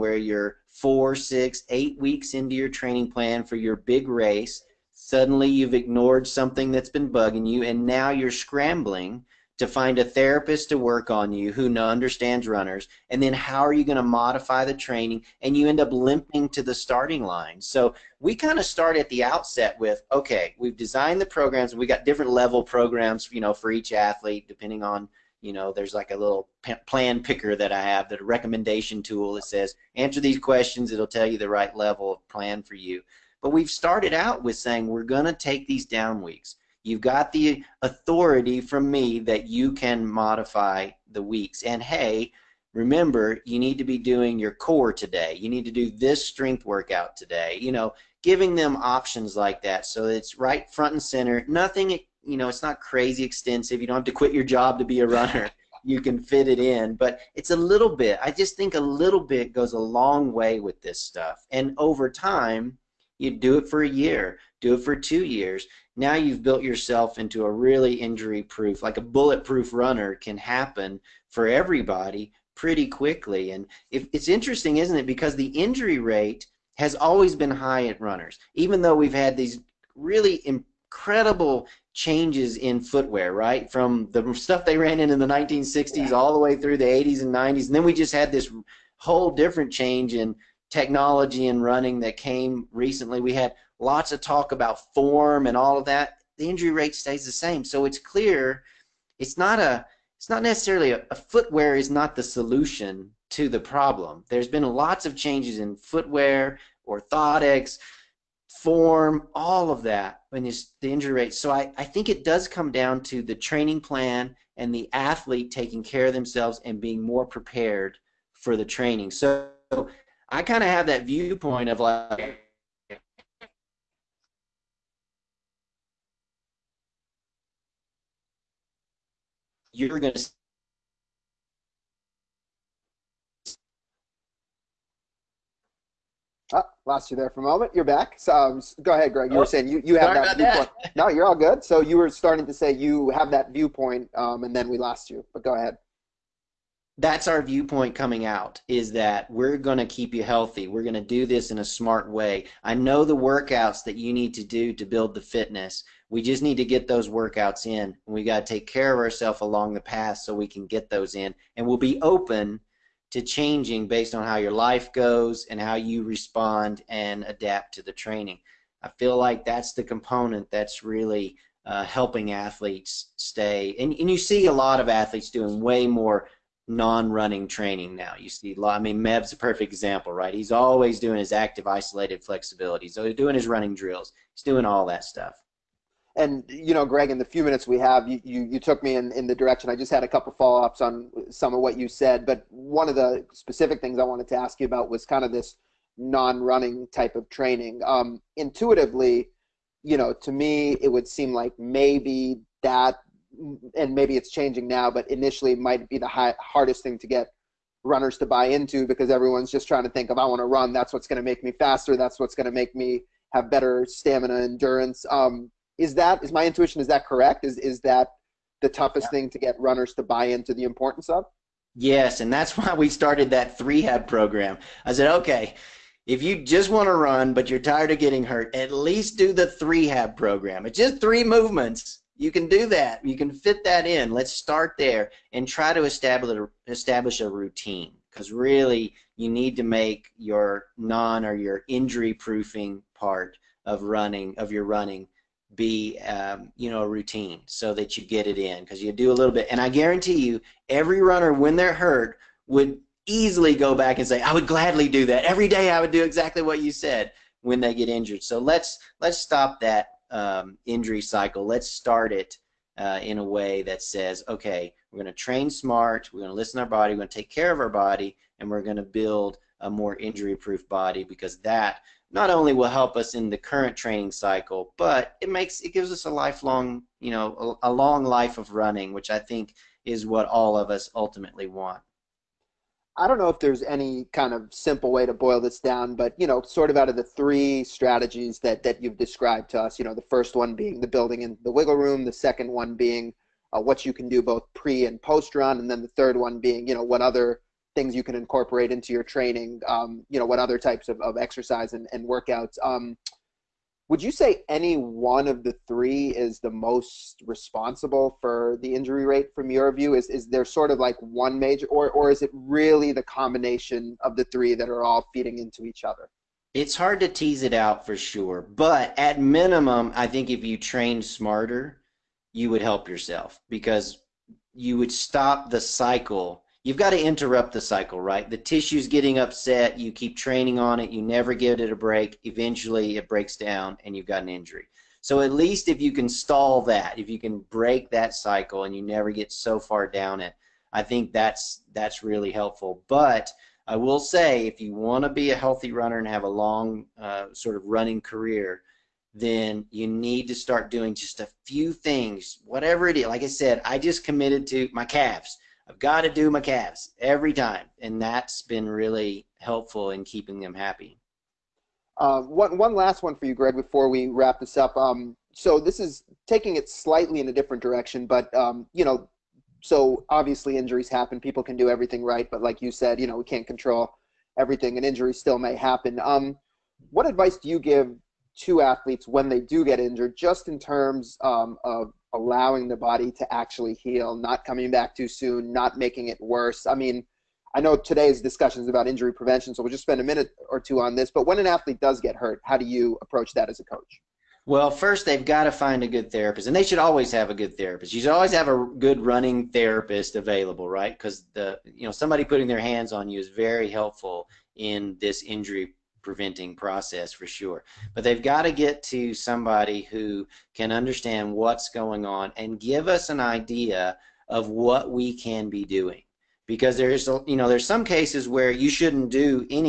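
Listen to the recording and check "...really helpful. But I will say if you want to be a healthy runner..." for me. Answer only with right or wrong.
right.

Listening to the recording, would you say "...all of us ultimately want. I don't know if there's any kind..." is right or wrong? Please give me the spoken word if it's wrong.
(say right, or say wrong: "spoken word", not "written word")
right.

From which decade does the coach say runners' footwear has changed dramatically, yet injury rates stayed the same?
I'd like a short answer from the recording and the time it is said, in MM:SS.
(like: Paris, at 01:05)
1960s, at 01:25.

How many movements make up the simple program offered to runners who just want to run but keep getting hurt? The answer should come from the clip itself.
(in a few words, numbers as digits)
3.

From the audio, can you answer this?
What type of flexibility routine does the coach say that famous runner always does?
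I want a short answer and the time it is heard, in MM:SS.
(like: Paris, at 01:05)
active isolated flexibility, at 03:01.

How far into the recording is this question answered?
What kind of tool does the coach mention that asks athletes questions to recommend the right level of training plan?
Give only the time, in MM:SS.
00:26.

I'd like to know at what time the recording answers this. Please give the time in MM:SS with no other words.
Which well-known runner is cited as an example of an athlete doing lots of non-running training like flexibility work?
02:59.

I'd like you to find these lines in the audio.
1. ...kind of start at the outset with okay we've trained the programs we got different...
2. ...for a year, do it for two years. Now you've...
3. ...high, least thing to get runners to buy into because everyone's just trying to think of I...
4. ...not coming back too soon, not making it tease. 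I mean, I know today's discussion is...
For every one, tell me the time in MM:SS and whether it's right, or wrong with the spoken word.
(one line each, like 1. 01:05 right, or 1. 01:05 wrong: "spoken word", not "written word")
1. 00:18 wrong: "designed", not "trained"
2. 01:03 right
3. 03:26 wrong: "hardest", not "least"
4. 06:24 wrong: "worse", not "tease".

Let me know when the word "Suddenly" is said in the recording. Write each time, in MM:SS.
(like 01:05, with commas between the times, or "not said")
00:05.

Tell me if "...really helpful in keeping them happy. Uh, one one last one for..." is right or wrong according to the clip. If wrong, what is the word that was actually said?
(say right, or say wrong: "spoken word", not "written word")
right.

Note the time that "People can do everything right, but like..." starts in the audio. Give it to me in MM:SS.
06:11.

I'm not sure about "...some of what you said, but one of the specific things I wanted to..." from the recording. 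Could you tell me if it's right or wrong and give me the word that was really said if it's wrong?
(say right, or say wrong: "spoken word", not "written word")
right.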